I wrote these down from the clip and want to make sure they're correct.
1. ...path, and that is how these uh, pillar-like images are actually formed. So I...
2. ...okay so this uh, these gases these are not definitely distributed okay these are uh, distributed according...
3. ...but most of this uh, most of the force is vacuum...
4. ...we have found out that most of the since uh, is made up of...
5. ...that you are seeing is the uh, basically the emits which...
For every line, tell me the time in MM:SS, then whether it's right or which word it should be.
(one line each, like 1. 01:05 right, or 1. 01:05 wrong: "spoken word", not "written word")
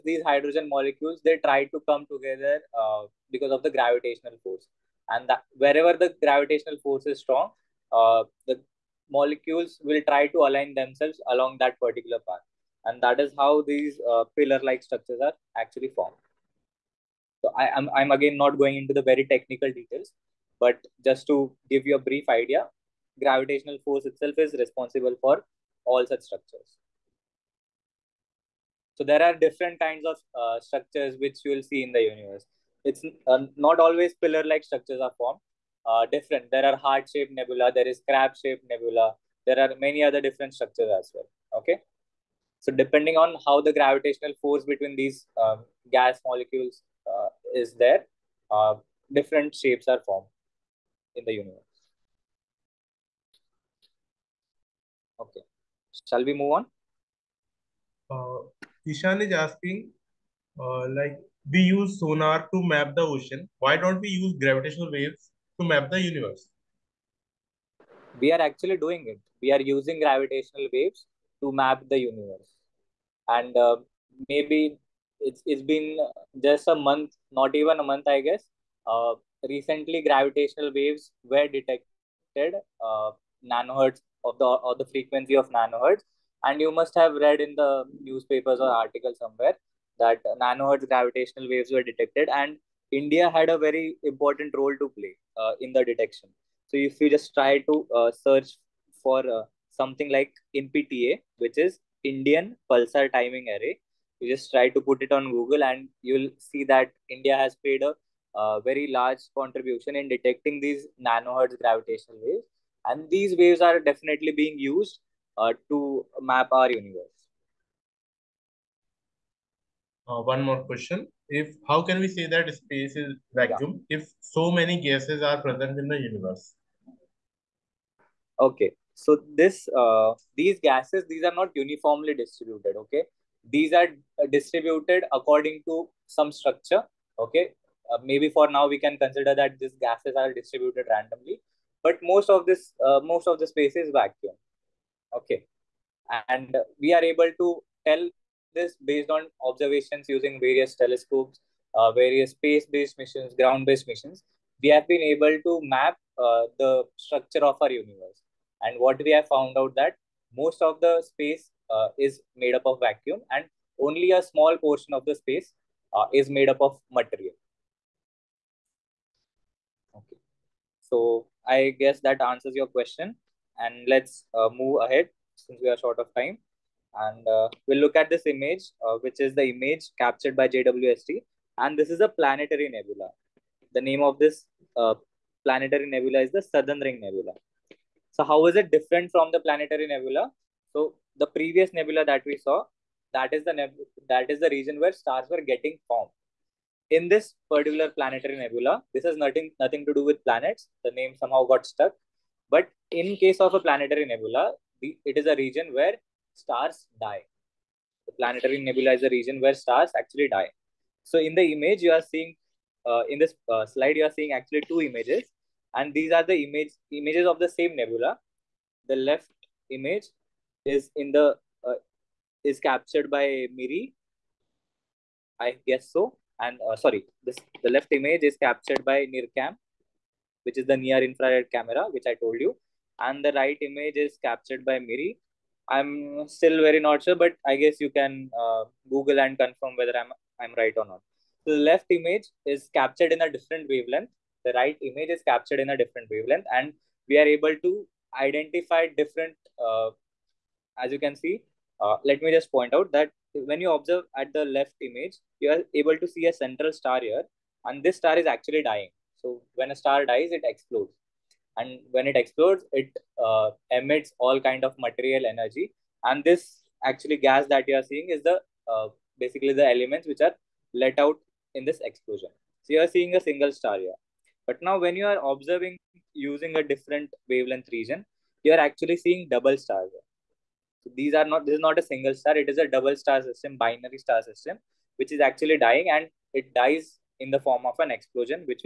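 1. 00:12 wrong: "structures", not "images"
2. 02:08 wrong: "uniformly", not "definitely"
3. 02:21 wrong: "space", not "force"
4. 02:39 wrong: "space", not "since"
5. 04:27 wrong: "elements", not "emits".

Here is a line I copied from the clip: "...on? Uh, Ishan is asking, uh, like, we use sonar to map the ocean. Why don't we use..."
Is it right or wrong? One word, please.
right.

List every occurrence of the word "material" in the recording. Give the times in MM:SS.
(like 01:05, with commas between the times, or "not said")
02:46, 04:24.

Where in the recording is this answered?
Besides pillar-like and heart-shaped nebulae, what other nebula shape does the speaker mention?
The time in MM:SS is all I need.
00:38.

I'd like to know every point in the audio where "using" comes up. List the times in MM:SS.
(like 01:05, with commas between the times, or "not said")
01:09, 02:30, 04:36.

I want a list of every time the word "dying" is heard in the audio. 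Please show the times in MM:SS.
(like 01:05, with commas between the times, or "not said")
04:18, 04:45.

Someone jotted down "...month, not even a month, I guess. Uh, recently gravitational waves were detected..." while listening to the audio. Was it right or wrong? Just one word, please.
right.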